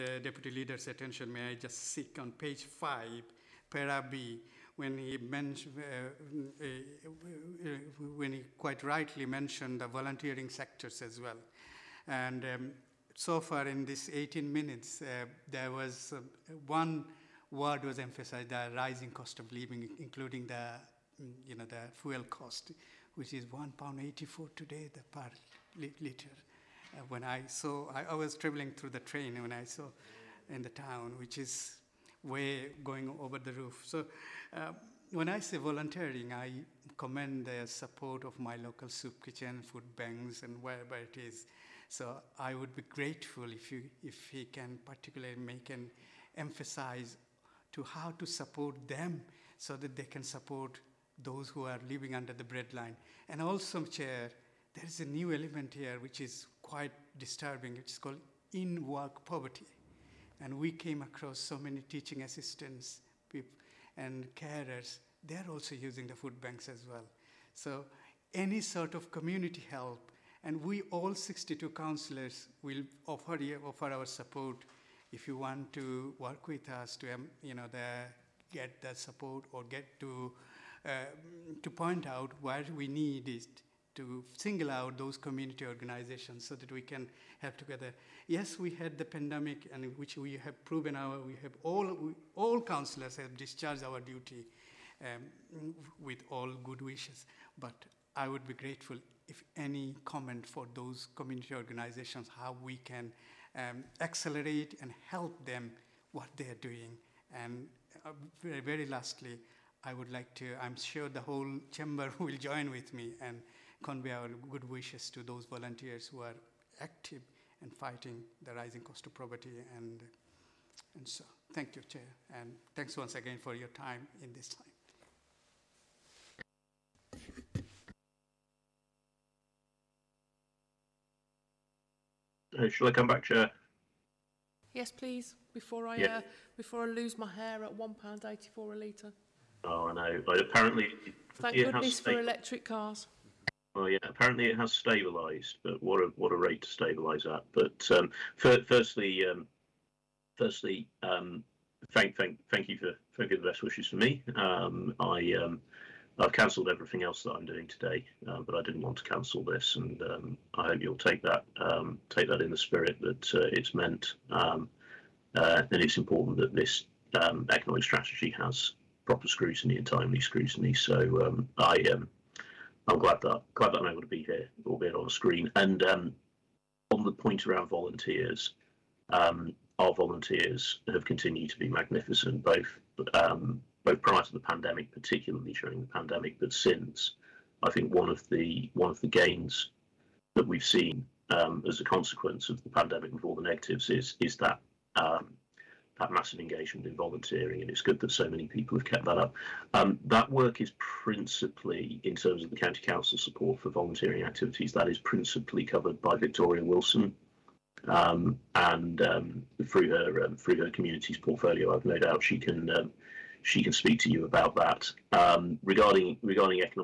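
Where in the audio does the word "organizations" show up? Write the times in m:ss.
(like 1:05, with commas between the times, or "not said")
1:25, 1:41.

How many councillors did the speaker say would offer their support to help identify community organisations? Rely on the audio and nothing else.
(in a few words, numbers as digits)
62.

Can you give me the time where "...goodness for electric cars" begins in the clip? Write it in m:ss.
2:21.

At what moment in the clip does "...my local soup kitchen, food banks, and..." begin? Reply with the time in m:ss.
0:38.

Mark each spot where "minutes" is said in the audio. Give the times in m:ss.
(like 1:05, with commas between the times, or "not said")
0:14.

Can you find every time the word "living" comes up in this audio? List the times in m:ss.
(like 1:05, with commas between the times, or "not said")
0:19, 0:51.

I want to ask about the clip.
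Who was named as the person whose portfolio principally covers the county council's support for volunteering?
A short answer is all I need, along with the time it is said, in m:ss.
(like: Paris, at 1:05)
Victoria Wilson, at 3:26.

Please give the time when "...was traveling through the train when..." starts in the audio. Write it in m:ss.
0:28.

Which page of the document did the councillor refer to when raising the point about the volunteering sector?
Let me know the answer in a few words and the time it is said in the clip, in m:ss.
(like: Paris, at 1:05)
Page 5, at 0:02.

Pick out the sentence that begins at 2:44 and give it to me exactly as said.
Uh, and it's important that this economic strategy has proper scrutiny and timely scrutiny.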